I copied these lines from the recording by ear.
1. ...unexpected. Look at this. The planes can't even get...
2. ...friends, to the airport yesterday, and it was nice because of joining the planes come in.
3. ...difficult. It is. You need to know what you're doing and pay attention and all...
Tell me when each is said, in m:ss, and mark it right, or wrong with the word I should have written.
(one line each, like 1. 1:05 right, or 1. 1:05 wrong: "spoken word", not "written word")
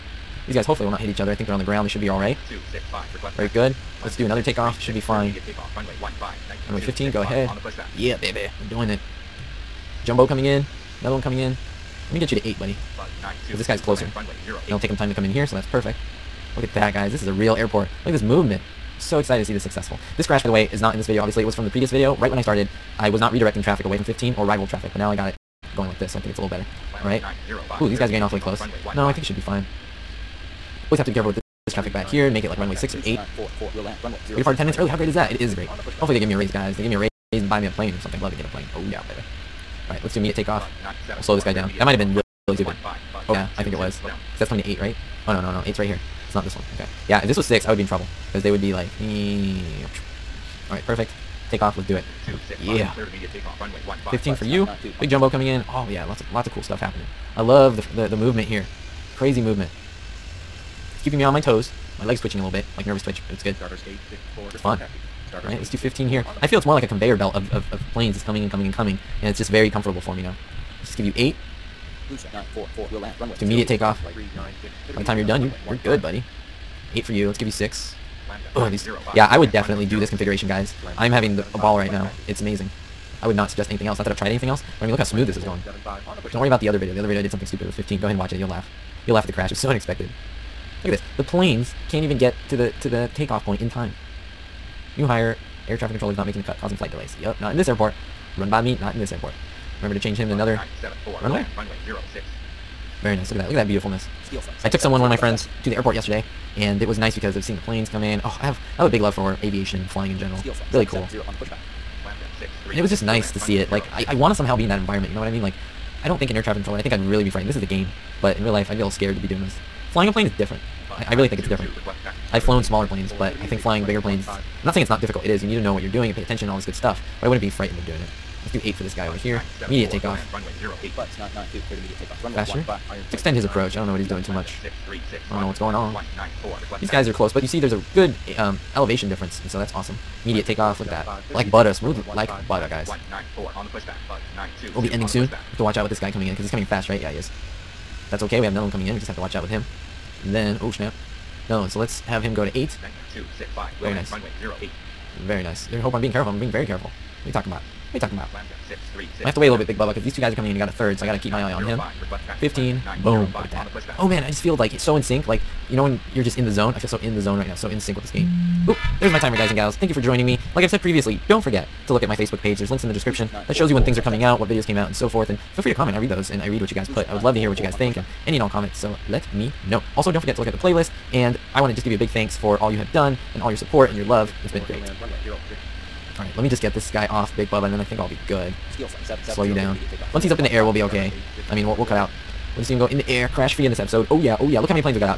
1. 1:29 right
2. 1:45 wrong: "seeing", not "joining"
3. 2:05 right.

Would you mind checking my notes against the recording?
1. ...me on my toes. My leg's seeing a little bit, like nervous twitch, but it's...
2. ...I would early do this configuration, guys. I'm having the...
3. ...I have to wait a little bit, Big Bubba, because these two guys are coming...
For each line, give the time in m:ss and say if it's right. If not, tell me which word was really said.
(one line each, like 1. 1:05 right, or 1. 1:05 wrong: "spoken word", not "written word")
1. 1:01 wrong: "twitching", not "seeing"
2. 1:19 wrong: "definitely", not "early"
3. 2:39 right.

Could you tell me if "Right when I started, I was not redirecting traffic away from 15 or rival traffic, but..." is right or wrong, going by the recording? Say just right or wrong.
right.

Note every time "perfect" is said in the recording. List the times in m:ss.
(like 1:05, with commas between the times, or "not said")
0:15, 0:50.